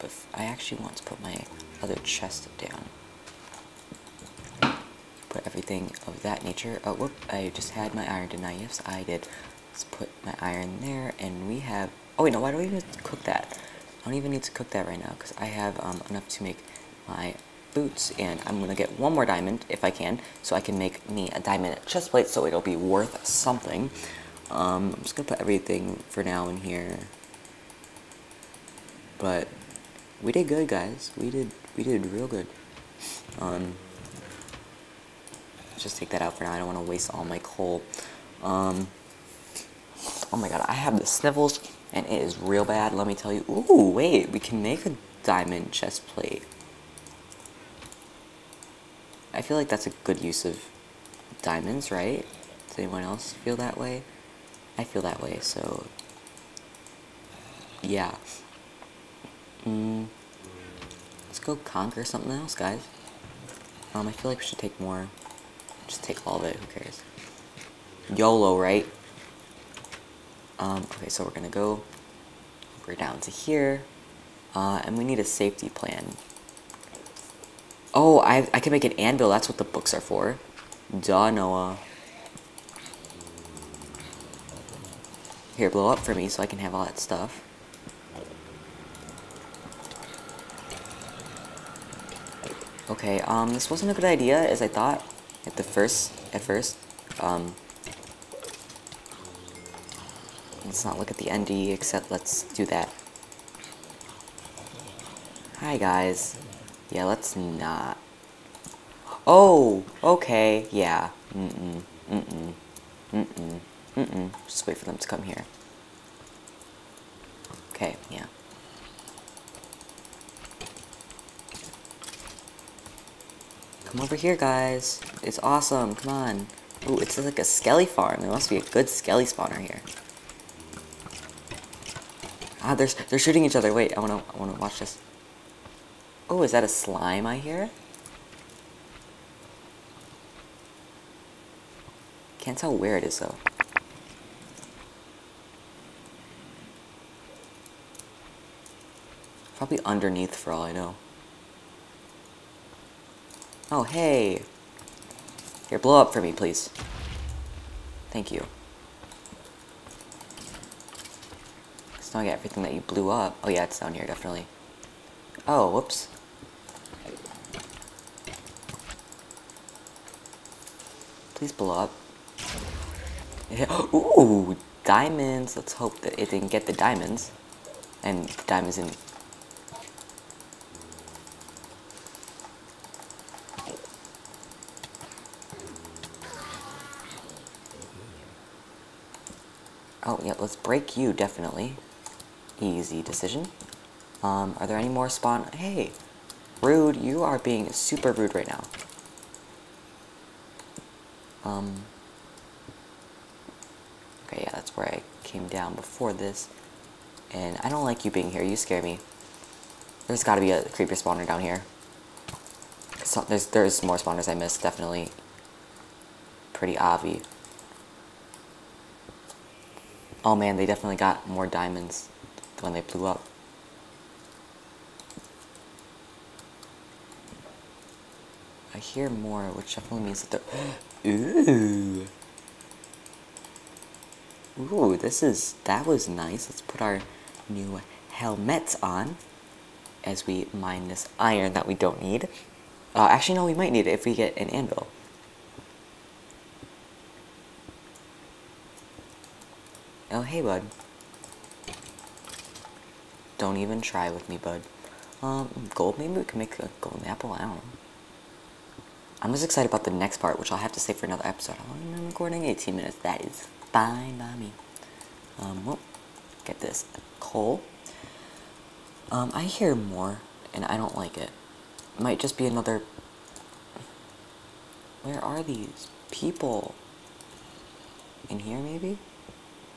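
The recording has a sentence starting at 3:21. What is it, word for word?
Um, okay, yeah, that's where I came down before this.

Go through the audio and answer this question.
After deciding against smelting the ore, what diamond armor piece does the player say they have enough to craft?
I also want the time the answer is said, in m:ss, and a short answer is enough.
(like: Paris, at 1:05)
boots, at 0:17.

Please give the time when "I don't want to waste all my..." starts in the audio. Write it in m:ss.
0:36.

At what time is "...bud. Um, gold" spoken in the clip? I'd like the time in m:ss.
4:14.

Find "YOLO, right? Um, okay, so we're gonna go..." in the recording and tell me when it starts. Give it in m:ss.
1:08.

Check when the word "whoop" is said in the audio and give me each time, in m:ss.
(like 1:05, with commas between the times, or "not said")
0:06, 2:45.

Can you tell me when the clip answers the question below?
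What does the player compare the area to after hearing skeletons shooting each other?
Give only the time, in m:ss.
2:07.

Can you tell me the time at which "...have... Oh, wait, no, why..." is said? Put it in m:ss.
0:11.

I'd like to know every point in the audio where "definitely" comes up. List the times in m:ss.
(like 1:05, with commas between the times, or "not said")
2:44, 3:11, 3:34, 3:40, 3:49.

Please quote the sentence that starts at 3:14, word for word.
Um, are there any more spawn?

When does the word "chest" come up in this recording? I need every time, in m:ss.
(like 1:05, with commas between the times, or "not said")
0:02, 0:21, 0:45.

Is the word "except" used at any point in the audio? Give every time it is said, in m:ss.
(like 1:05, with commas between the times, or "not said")
1:41.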